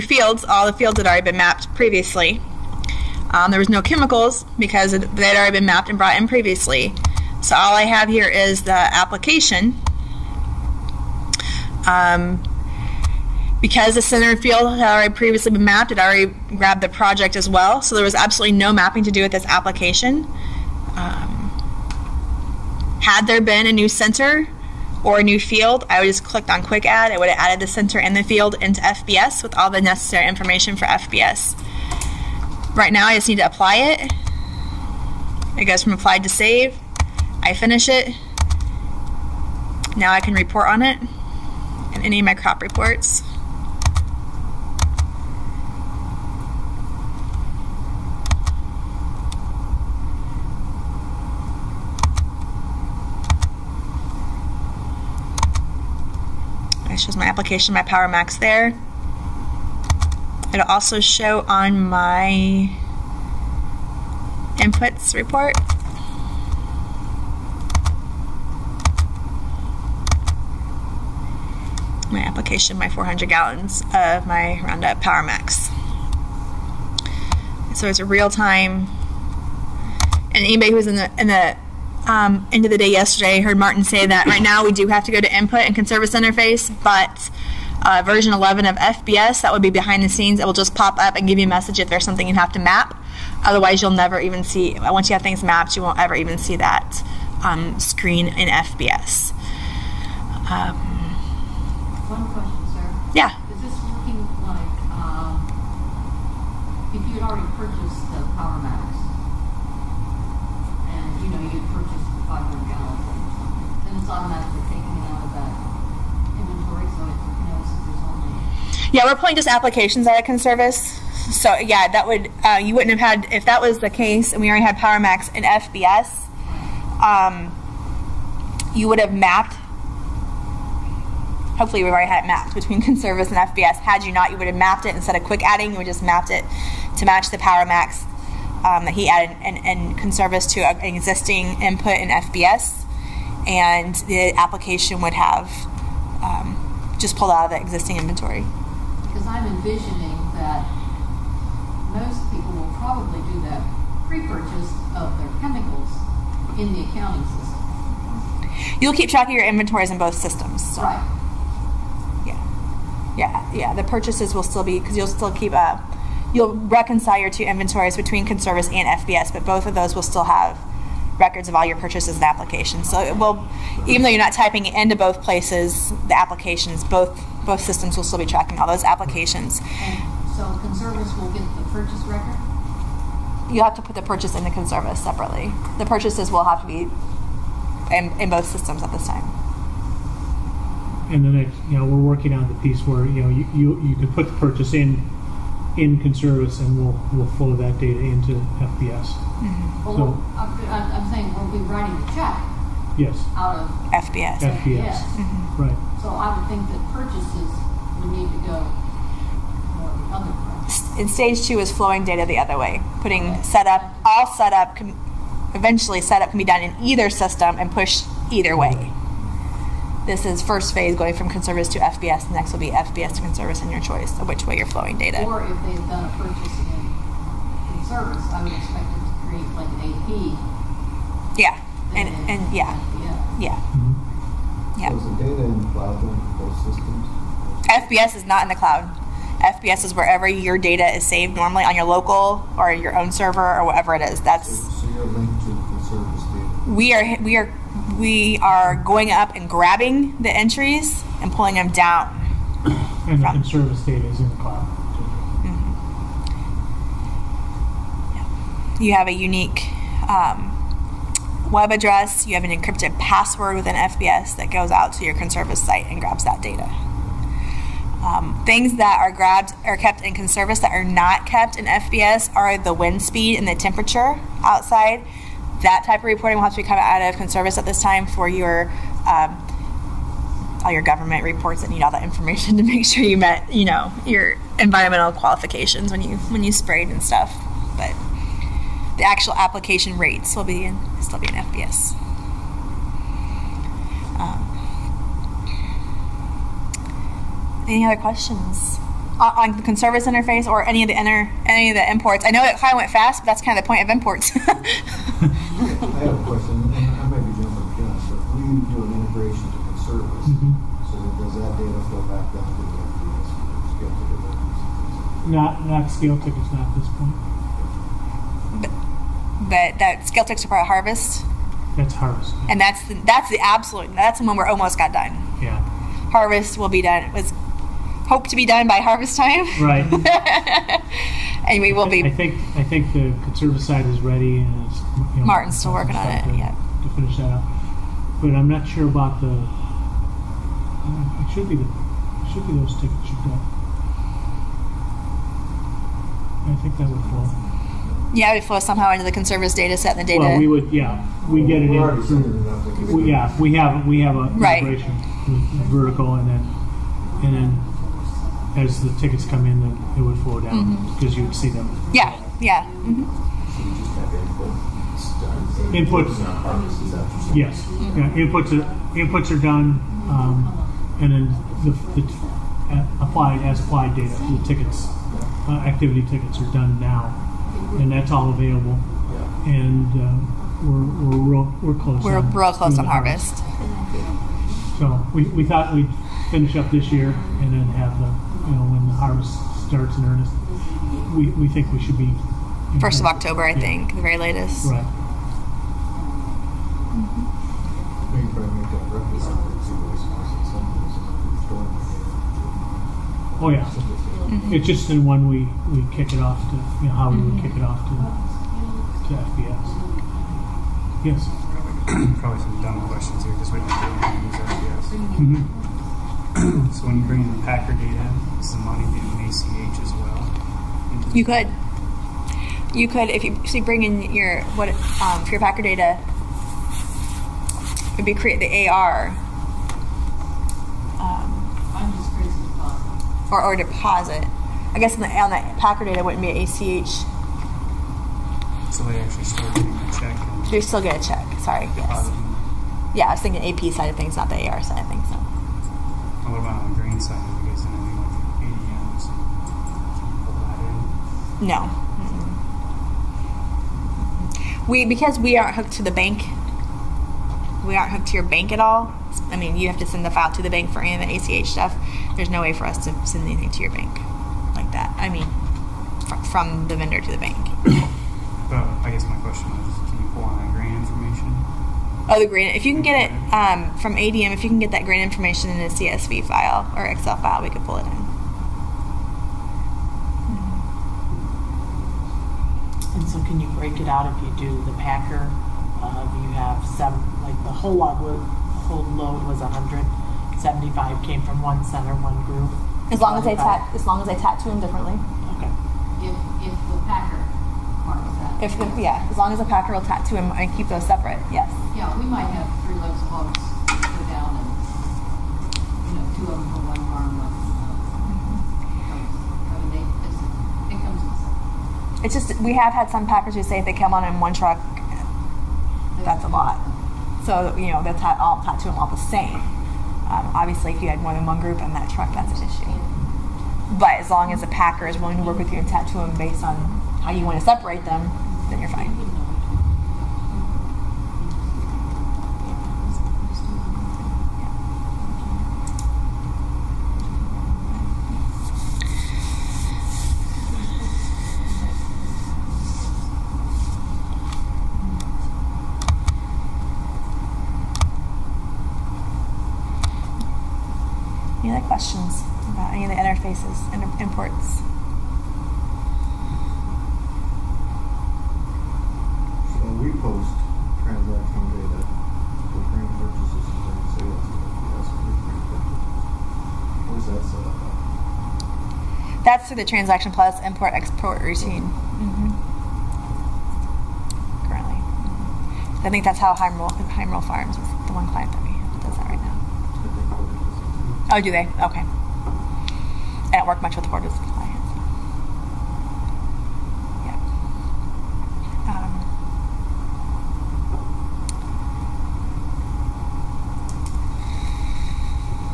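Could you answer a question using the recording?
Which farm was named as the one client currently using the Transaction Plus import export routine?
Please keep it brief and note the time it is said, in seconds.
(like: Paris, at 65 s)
Heimroll Farms, at 576 s.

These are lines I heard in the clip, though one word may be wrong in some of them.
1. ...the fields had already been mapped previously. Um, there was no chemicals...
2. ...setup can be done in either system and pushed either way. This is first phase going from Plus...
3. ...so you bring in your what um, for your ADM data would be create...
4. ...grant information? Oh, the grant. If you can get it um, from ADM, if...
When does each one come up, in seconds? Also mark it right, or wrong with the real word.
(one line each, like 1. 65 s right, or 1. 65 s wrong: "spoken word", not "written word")
1. 0 s right
2. 216 s wrong: "Conservis", not "Plus"
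3. 423 s wrong: "Packer", not "ADM"
4. 470 s right.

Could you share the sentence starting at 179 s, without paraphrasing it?
And so Conservis will get the purchase record?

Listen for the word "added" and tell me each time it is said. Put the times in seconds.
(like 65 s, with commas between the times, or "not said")
27 s, 139 s.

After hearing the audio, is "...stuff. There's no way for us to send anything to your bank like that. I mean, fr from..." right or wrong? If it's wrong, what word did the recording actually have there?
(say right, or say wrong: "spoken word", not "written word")
right.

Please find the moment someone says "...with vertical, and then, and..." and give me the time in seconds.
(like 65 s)
355 s.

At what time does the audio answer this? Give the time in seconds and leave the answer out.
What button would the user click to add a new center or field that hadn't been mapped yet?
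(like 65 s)
26 s.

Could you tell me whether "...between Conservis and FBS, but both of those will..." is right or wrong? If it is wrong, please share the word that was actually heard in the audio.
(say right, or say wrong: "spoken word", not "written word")
right.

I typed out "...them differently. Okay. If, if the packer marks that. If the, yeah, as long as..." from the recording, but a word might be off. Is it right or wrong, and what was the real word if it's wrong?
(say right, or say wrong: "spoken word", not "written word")
right.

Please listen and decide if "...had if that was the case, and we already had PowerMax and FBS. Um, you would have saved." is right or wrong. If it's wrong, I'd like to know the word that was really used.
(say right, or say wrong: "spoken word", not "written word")
wrong: "mapped", not "saved".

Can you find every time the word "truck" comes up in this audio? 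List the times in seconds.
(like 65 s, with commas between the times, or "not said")
514 s, 521 s.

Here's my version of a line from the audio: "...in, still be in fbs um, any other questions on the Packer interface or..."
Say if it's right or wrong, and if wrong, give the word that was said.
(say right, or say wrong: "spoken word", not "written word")
wrong: "Conservis", not "Packer".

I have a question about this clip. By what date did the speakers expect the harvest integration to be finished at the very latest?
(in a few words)
first of October.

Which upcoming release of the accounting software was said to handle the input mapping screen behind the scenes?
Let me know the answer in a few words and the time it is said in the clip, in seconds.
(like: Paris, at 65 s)
version 11, at 88 s.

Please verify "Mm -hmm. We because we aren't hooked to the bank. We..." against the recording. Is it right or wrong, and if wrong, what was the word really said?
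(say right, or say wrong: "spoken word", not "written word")
right.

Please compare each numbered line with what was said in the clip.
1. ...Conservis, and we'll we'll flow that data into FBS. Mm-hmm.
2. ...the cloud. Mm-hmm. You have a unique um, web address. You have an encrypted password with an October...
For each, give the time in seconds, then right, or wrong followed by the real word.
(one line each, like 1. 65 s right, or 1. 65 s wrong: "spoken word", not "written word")
1. 196 s right
2. 254 s wrong: "FBS", not "October".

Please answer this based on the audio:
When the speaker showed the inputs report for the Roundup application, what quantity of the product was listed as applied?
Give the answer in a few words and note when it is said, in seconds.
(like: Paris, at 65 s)
400 gallons, at 72 s.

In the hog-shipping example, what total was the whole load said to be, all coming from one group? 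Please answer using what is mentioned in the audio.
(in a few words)
175.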